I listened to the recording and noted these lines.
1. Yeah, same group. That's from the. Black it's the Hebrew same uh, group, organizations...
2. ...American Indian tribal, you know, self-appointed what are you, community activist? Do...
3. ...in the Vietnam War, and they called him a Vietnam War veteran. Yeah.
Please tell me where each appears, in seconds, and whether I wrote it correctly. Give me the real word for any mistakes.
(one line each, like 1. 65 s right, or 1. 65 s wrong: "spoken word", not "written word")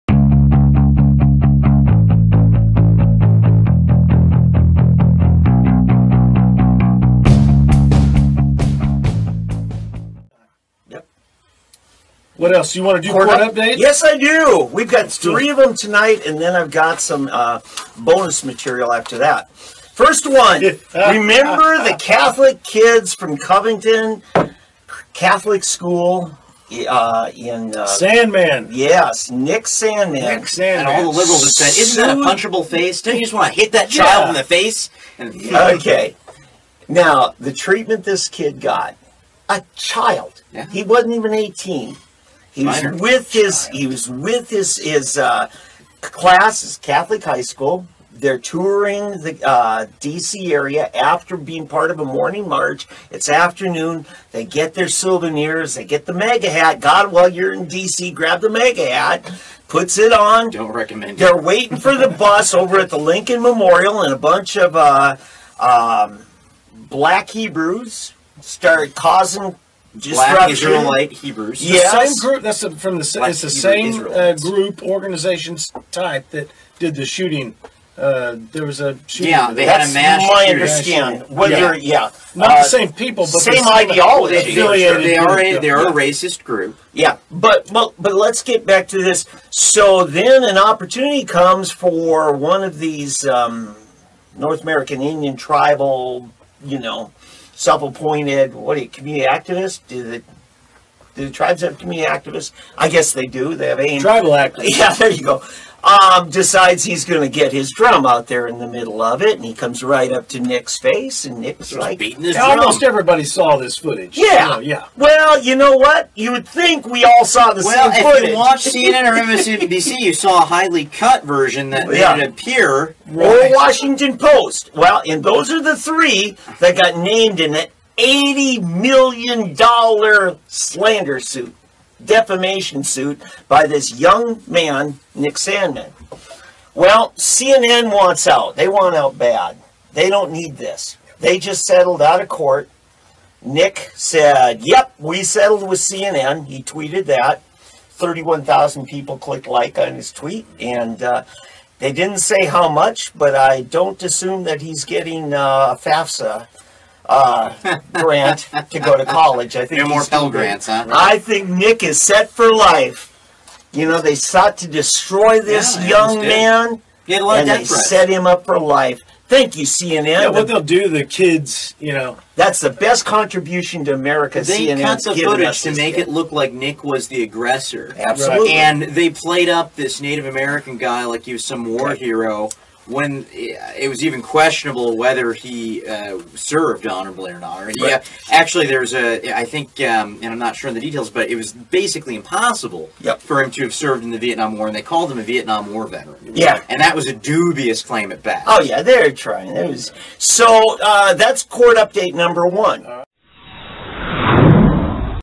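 1. 71 s right
2. 94 s right
3. 194 s right.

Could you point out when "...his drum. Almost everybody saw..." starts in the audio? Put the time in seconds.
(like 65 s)
112 s.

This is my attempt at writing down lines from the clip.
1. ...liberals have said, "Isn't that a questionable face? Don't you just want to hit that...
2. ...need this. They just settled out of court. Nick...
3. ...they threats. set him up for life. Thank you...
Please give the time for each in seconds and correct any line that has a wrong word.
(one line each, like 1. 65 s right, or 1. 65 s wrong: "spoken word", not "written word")
1. 31 s wrong: "punchable", not "questionable"
2. 140 s right
3. 167 s right.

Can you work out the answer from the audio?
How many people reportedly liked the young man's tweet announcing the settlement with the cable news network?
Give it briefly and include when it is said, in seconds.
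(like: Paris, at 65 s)
31,000, at 147 s.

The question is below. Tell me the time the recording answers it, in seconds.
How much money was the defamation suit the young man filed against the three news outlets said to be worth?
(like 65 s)
128 s.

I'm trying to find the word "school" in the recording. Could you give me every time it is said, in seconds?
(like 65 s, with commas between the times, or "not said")
25 s, 47 s.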